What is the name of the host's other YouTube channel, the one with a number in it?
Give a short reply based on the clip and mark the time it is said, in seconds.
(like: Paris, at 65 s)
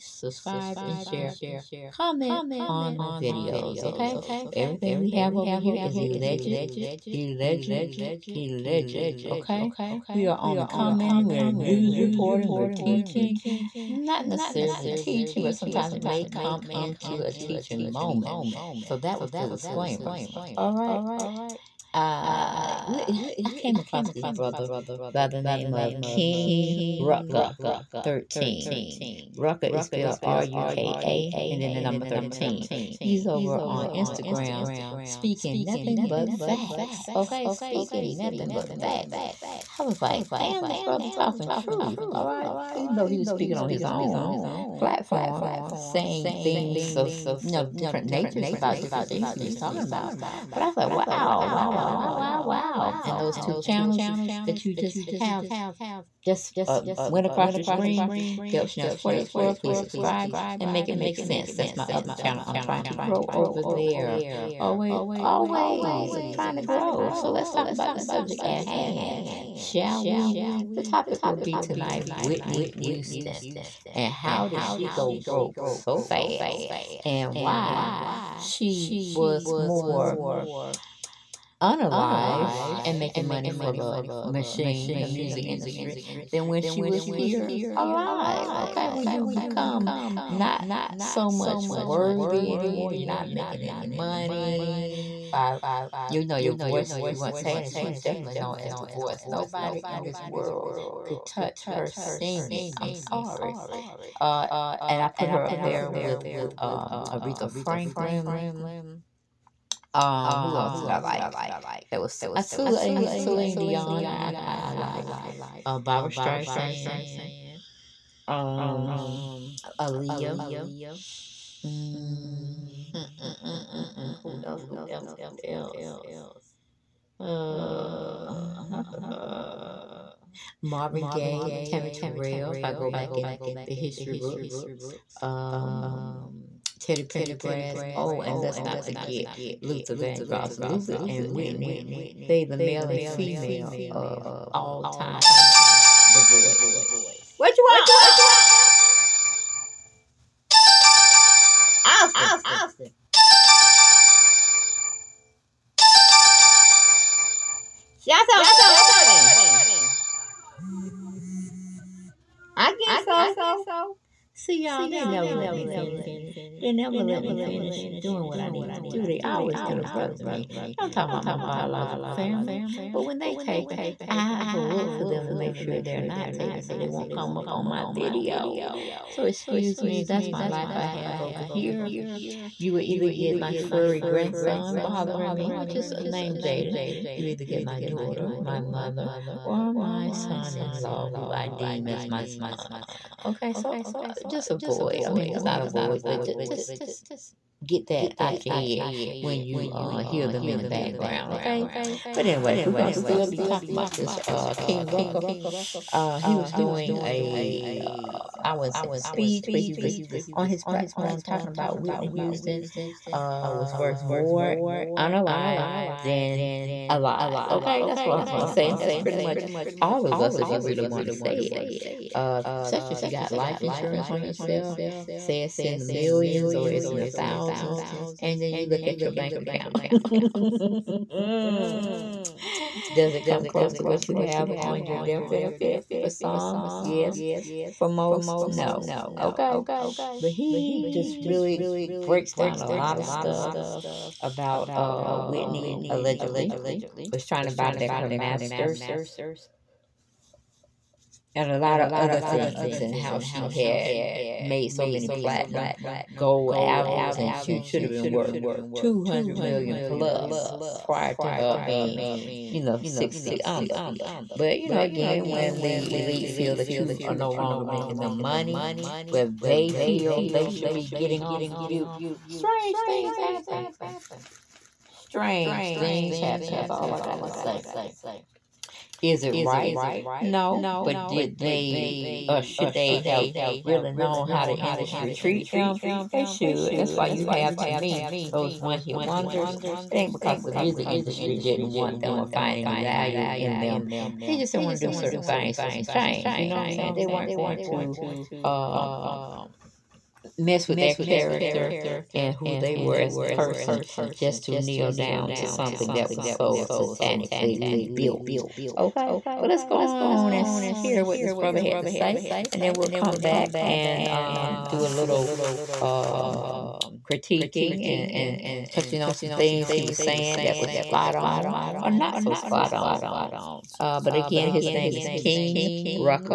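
Deb Shanel's 48th World, at 58 s.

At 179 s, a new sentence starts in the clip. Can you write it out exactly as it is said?
So excuse me, that's my life I have over here.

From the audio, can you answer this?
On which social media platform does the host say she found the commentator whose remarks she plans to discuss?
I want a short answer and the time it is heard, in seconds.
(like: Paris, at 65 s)
Instagram, at 33 s.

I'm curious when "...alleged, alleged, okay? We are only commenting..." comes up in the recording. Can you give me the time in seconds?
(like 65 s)
7 s.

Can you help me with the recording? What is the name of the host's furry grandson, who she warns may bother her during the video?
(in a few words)
Jaden.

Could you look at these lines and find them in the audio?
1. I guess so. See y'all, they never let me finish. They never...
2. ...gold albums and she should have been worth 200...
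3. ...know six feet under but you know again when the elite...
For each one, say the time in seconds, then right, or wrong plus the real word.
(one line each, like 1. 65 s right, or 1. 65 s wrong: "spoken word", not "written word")
1. 162 s right
2. 256 s right
3. 262 s right.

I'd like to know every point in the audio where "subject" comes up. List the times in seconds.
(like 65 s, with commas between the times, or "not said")
67 s.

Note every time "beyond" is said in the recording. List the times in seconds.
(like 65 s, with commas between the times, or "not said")
not said.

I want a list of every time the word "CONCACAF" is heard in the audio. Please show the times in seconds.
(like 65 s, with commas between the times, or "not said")
not said.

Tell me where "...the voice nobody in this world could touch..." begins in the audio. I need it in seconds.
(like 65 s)
98 s.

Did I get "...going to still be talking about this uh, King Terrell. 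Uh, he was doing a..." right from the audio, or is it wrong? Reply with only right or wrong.
wrong.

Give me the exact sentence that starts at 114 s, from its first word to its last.
I I, I like uh, Barbra Streisand, um, Aaliyah.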